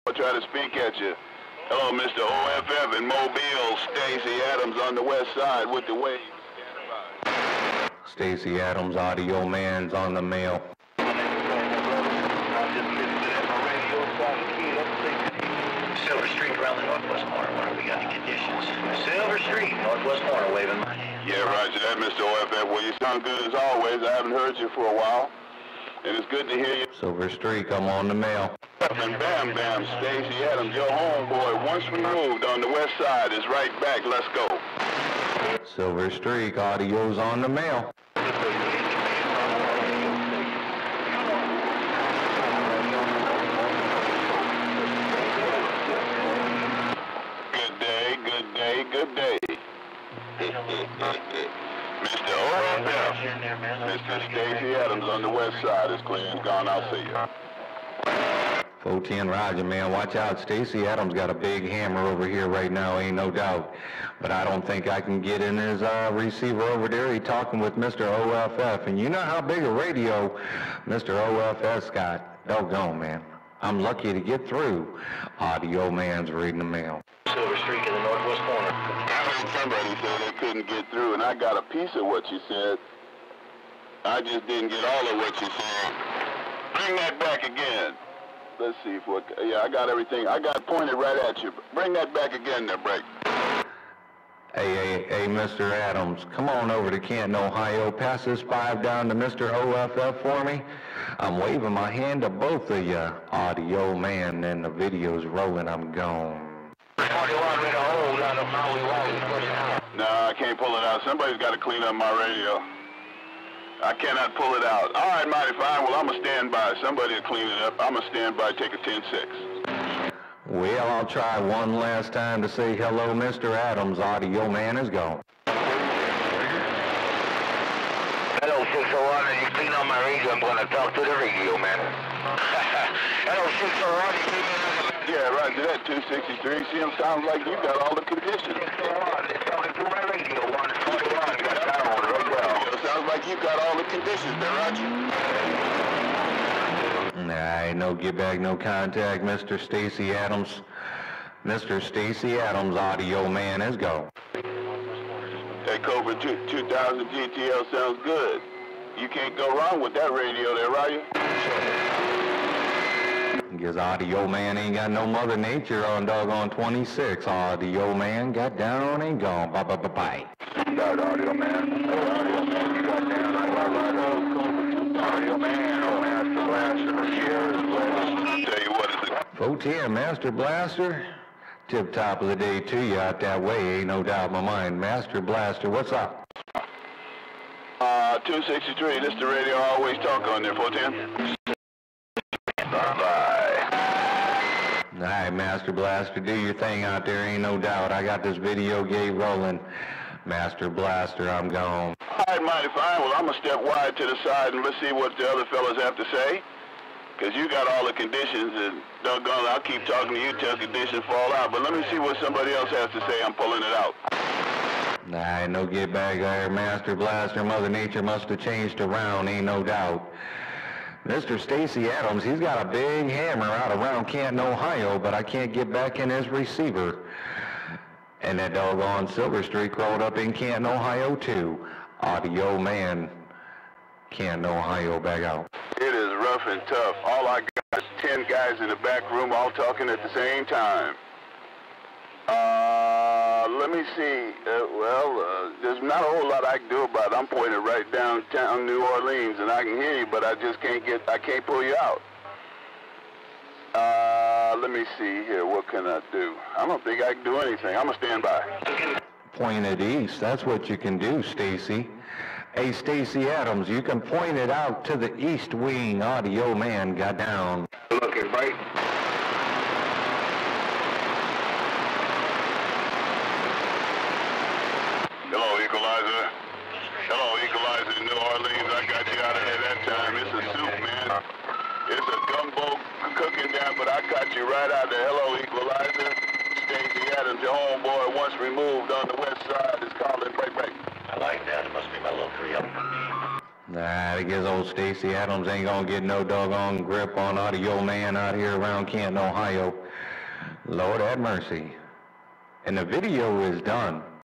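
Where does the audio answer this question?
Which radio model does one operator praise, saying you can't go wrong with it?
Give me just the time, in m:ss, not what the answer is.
2:35.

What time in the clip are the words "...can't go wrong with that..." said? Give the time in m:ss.
2:39.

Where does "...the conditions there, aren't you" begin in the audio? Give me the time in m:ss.
2:23.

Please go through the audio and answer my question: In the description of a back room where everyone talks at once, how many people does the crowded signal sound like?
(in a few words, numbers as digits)
10.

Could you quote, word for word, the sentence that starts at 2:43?
Because audio man ain't got no mother nature on doggone 26.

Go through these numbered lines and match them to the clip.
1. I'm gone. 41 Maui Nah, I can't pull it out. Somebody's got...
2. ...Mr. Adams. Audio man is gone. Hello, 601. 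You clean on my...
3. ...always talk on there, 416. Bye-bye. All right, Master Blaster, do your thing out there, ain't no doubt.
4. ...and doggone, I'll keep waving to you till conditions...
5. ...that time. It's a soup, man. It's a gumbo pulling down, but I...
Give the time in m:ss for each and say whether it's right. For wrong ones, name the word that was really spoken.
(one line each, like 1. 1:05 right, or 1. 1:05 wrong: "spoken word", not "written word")
1. 1:45 right
2. 2:03 right
3. 3:09 wrong: "410", not "416"
4. 3:28 wrong: "talking", not "waving"
5. 4:39 wrong: "cooking", not "pulling".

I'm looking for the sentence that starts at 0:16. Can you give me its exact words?
Silver Streak around the northwest corner.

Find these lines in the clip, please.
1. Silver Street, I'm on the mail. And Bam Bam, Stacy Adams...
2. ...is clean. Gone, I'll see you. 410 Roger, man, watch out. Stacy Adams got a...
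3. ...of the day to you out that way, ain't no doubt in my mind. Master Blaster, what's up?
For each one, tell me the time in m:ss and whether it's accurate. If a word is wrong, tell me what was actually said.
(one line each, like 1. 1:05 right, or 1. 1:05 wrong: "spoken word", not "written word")
1. 0:26 right
2. 0:55 right
3. 3:02 right.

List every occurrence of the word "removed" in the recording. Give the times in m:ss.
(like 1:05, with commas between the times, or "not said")
0:31, 4:48.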